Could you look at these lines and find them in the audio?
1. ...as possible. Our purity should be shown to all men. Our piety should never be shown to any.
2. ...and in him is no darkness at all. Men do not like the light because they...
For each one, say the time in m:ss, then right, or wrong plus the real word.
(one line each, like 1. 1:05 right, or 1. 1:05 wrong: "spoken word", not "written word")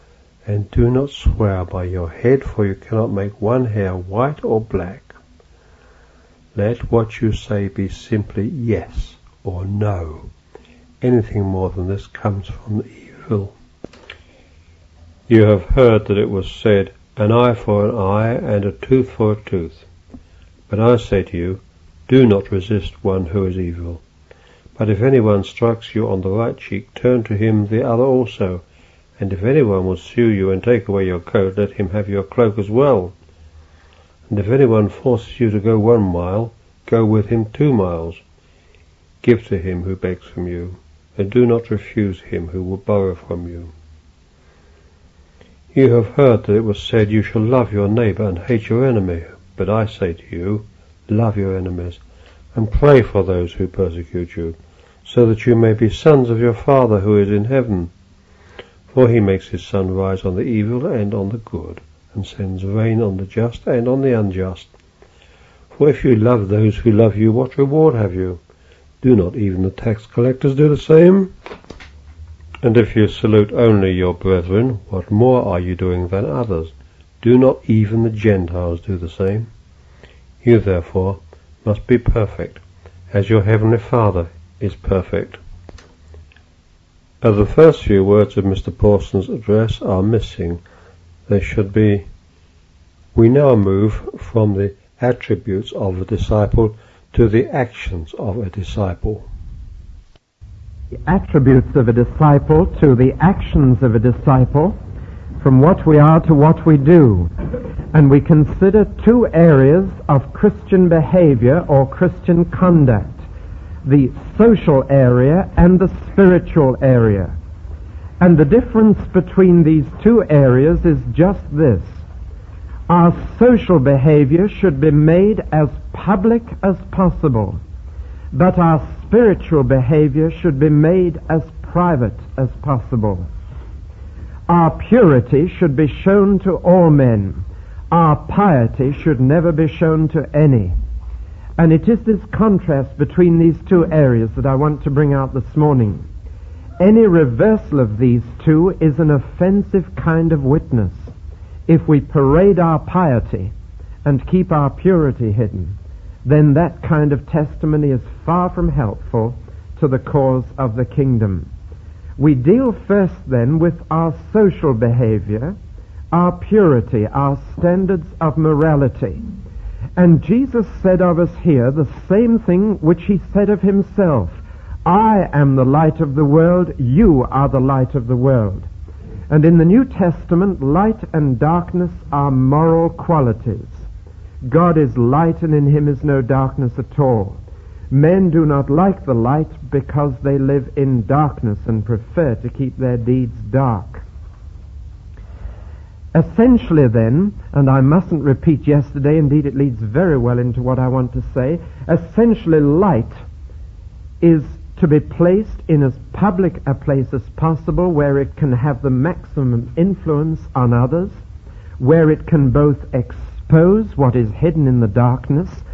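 1. 2:12 right
2. 3:05 right.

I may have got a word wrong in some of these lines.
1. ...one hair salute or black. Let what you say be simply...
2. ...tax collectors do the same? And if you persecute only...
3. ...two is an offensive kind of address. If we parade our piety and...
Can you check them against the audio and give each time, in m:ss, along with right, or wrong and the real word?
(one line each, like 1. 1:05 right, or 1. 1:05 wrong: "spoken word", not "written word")
1. 0:03 wrong: "white", not "salute"
2. 1:09 wrong: "salute", not "persecute"
3. 2:28 wrong: "witness", not "address".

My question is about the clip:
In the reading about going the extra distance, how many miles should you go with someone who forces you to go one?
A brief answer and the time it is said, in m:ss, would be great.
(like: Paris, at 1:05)
2, at 0:37.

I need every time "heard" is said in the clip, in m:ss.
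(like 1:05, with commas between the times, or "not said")
0:15, 0:46.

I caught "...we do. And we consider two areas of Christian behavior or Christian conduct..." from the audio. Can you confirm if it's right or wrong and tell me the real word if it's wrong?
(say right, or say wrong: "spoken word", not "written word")
right.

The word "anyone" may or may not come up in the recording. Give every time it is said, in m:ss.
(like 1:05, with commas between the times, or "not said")
0:25, 0:29, 0:34.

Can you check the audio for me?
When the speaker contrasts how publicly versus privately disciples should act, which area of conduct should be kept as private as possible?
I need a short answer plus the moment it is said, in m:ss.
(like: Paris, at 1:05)
Spiritual behavior, at 2:09.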